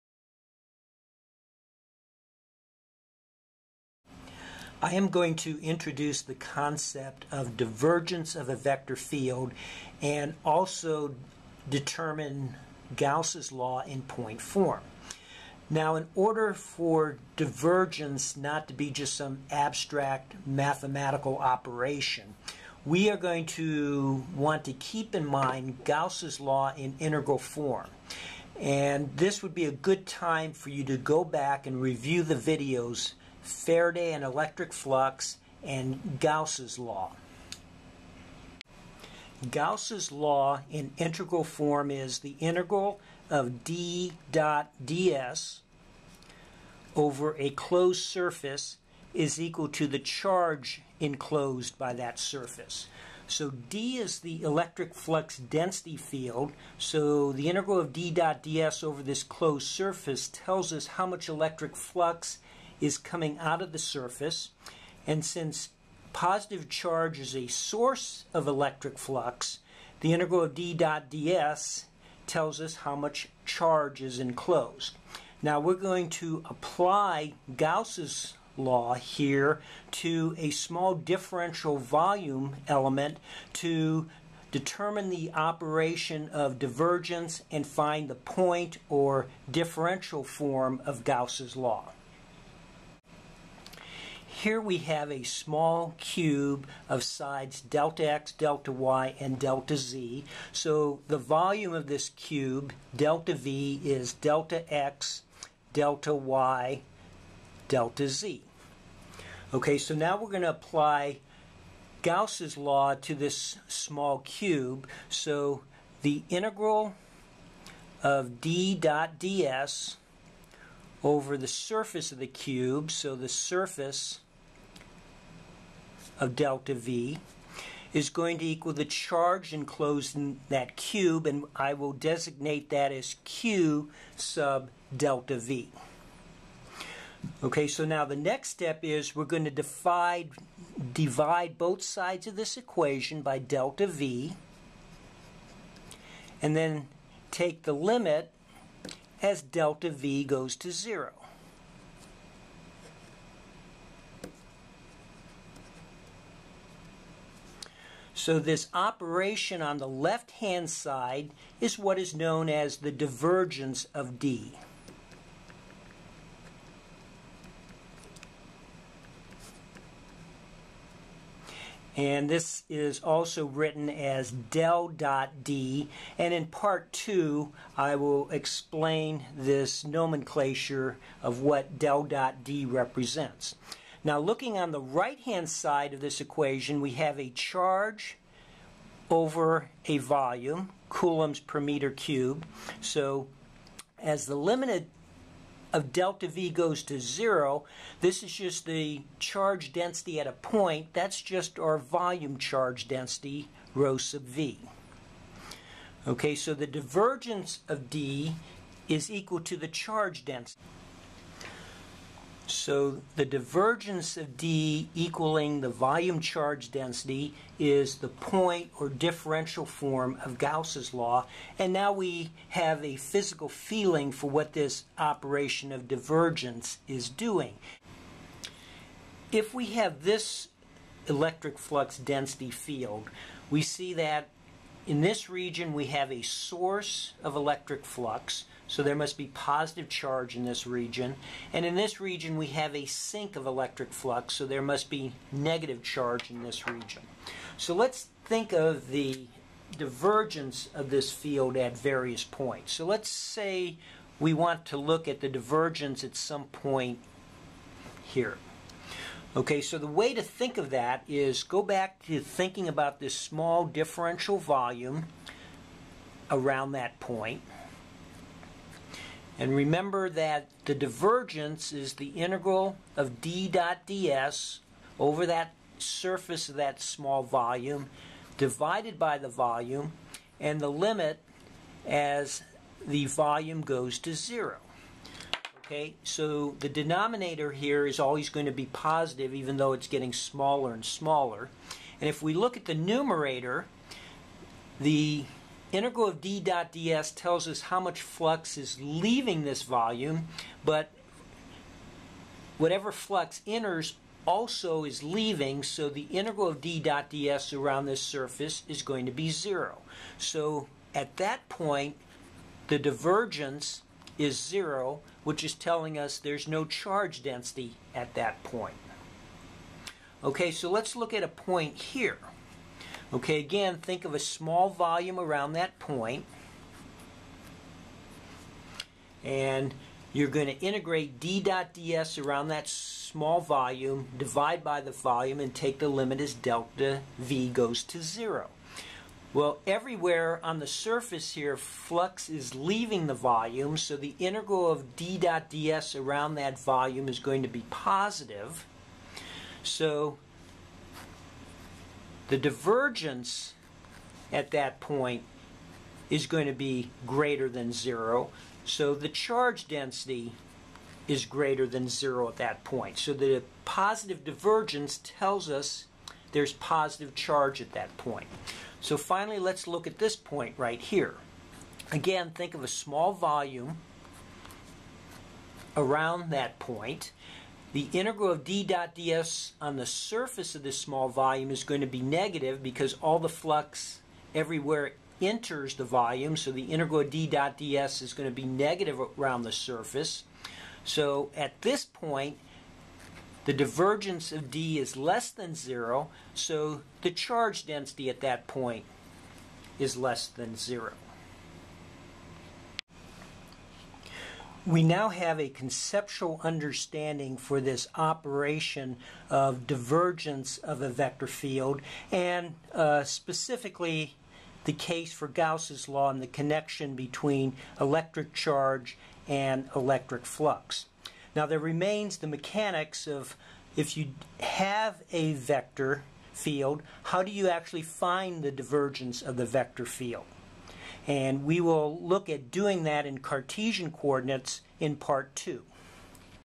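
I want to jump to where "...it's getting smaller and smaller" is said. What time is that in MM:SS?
04:49.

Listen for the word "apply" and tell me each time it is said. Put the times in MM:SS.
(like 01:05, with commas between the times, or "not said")
01:16, 01:50.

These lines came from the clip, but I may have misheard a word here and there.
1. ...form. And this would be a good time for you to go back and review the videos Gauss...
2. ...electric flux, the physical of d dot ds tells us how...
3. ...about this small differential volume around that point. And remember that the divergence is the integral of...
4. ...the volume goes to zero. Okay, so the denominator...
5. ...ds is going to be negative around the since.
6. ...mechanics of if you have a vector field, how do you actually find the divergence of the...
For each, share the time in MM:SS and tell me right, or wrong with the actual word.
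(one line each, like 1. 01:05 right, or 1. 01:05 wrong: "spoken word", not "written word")
1. 00:27 wrong: "Faraday", not "Gauss"
2. 01:08 wrong: "integral", not "physical"
3. 04:22 right
4. 04:42 right
5. 06:27 wrong: "surface", not "since"
6. 07:02 right.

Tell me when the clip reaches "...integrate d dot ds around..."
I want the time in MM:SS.
05:30.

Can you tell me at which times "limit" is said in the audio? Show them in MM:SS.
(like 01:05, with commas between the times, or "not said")
02:27, 03:14, 04:40, 05:35.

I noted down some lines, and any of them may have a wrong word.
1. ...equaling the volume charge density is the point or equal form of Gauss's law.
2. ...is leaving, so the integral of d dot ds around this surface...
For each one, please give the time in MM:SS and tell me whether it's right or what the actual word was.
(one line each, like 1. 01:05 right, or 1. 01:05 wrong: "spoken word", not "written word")
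1. 03:34 wrong: "differential", not "equal"
2. 05:04 right.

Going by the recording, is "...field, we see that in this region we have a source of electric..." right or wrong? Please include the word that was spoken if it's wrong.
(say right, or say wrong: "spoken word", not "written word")
right.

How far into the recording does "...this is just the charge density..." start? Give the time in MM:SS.
03:17.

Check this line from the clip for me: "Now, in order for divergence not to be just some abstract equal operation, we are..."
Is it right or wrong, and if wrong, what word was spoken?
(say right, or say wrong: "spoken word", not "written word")
wrong: "mathematical", not "equal".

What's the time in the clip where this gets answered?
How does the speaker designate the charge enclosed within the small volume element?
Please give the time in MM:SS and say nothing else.
02:13.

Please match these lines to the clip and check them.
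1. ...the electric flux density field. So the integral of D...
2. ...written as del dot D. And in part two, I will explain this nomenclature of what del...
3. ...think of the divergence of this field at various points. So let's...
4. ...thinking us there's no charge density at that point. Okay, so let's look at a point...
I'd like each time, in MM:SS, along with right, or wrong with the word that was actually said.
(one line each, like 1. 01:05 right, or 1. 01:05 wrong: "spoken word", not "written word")
1. 00:54 right
2. 02:53 right
3. 04:08 right
4. 05:15 wrong: "telling", not "thinking".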